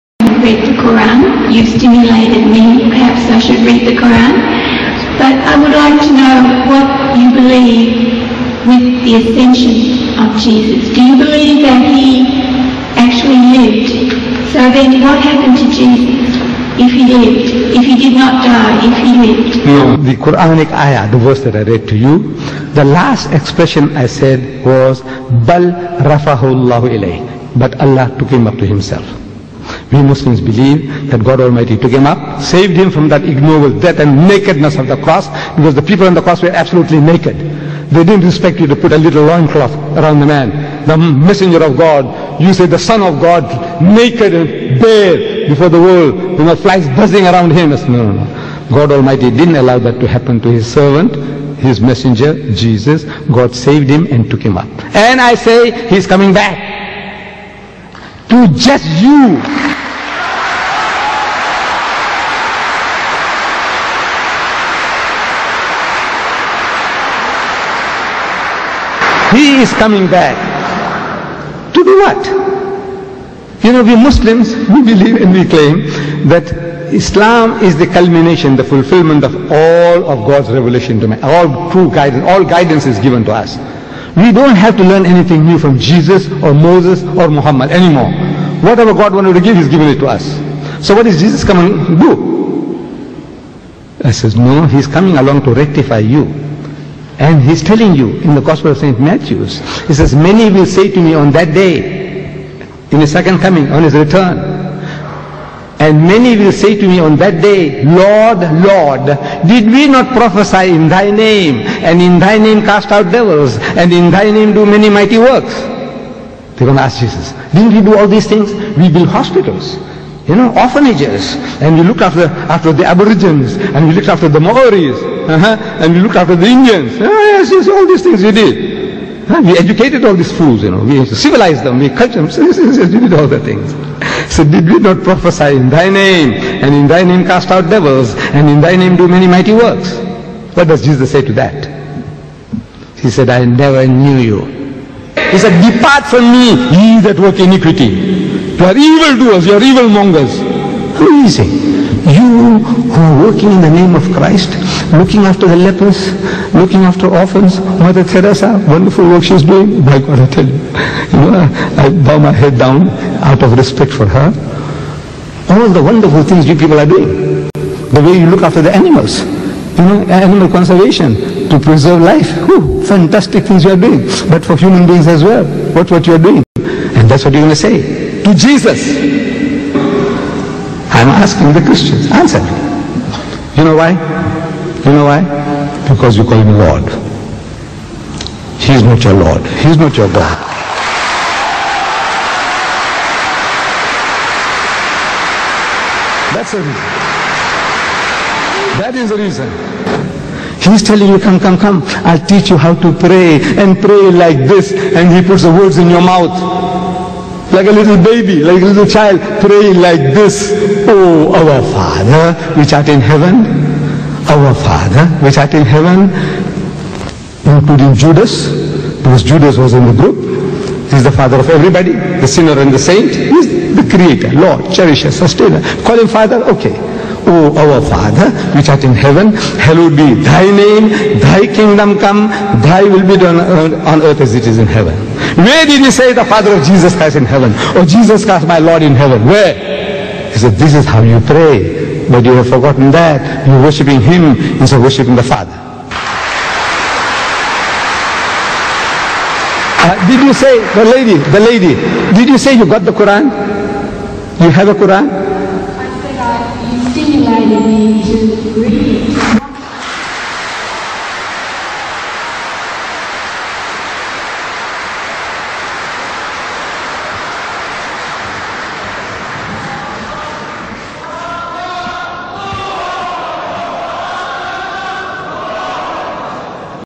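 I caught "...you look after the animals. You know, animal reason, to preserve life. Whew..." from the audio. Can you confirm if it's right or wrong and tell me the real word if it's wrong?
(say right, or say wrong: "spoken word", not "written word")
wrong: "conservation", not "reason".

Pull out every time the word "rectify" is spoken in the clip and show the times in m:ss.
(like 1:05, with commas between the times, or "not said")
1:35.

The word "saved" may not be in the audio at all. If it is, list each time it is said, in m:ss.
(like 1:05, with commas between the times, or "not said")
0:32, 0:53.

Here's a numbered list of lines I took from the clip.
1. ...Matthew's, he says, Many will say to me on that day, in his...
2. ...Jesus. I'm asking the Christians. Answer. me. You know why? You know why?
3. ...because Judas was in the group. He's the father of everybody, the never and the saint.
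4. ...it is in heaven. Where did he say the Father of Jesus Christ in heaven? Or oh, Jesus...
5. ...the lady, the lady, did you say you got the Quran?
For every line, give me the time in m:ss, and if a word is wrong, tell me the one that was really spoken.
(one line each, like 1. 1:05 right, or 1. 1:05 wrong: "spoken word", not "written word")
1. 1:38 right
2. 2:58 right
3. 3:39 wrong: "sinner", not "never"
4. 3:54 right
5. 4:10 right.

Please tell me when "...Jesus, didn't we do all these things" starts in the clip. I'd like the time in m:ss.
1:57.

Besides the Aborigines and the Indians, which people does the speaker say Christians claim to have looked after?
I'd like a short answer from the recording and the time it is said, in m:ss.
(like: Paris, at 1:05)
The Maoris, at 2:04.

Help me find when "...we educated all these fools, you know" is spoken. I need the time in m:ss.
2:09.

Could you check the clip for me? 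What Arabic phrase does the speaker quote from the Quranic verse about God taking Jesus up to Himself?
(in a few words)
Bal rafahu Allah ilayh.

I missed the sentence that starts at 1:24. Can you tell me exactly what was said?
We don't have to learn anything new from Jesus or Moses or Muhammad anymore.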